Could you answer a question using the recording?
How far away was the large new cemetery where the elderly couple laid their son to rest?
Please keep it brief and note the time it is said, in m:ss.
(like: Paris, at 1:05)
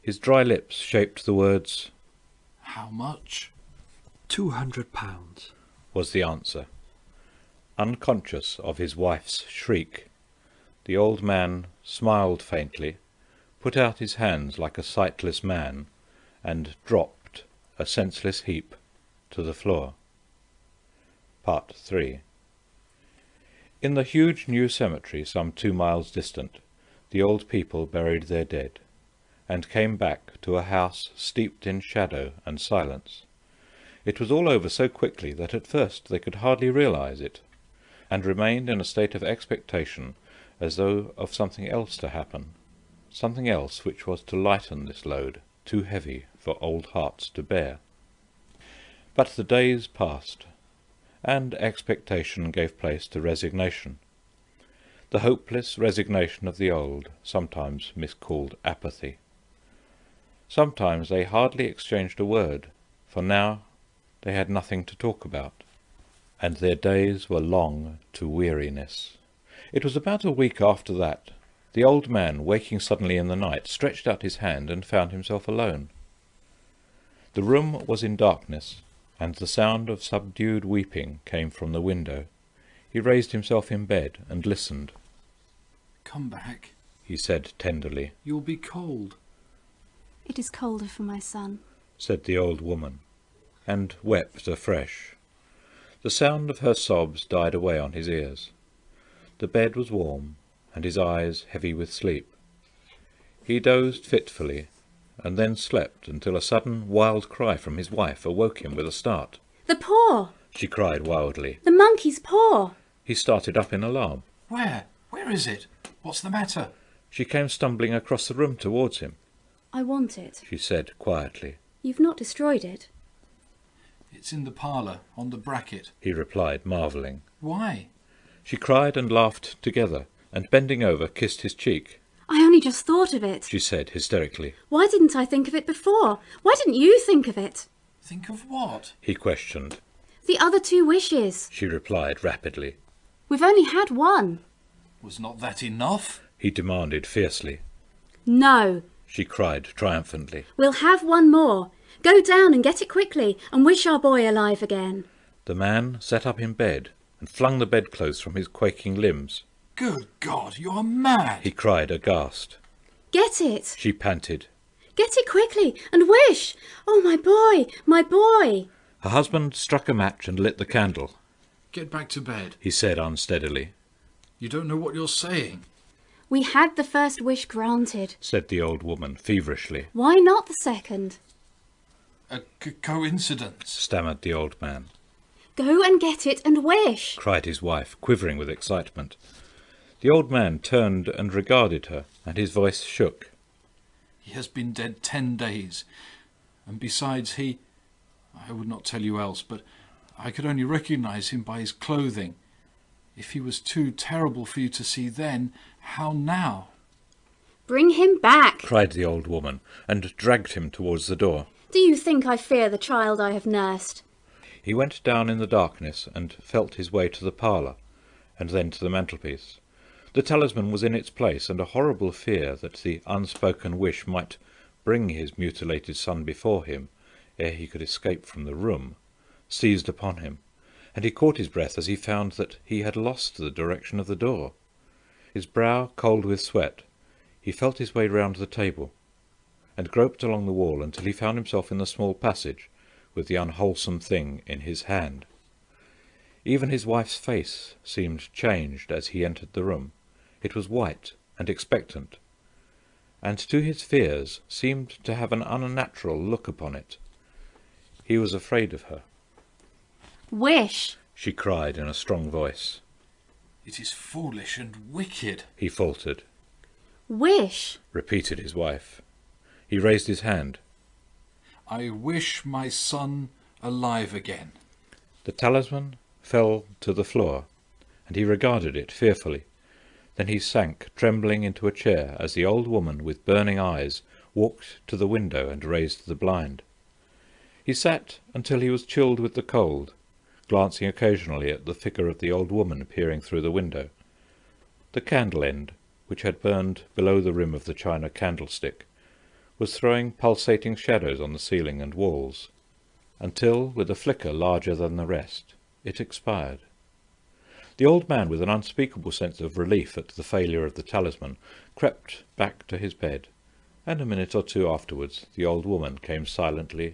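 2 miles, at 0:25.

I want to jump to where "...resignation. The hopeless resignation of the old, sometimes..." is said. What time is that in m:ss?
0:53.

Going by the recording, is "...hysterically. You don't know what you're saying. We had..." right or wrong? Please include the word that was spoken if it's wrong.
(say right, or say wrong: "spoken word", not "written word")
wrong: "unsteadily", not "hysterically".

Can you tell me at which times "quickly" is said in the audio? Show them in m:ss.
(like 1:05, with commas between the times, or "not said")
0:34, 2:32, 2:45.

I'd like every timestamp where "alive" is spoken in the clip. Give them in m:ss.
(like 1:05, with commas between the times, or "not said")
2:34, 4:33.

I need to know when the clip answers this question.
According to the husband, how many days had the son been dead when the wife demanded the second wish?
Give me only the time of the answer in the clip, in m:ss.
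3:15.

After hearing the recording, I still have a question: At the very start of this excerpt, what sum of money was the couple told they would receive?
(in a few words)
200 pounds.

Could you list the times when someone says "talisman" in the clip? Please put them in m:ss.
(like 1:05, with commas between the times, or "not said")
3:40, 4:35, 5:10.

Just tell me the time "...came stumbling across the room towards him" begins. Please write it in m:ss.
1:57.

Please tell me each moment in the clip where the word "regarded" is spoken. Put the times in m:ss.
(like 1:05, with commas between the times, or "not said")
3:11, 4:38.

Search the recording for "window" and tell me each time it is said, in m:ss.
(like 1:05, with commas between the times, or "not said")
1:21, 4:45, 4:53.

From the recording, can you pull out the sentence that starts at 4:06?
Even his wife's face seemed changed as he entered the room.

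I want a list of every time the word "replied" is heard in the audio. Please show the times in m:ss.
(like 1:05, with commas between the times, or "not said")
2:06, 2:21.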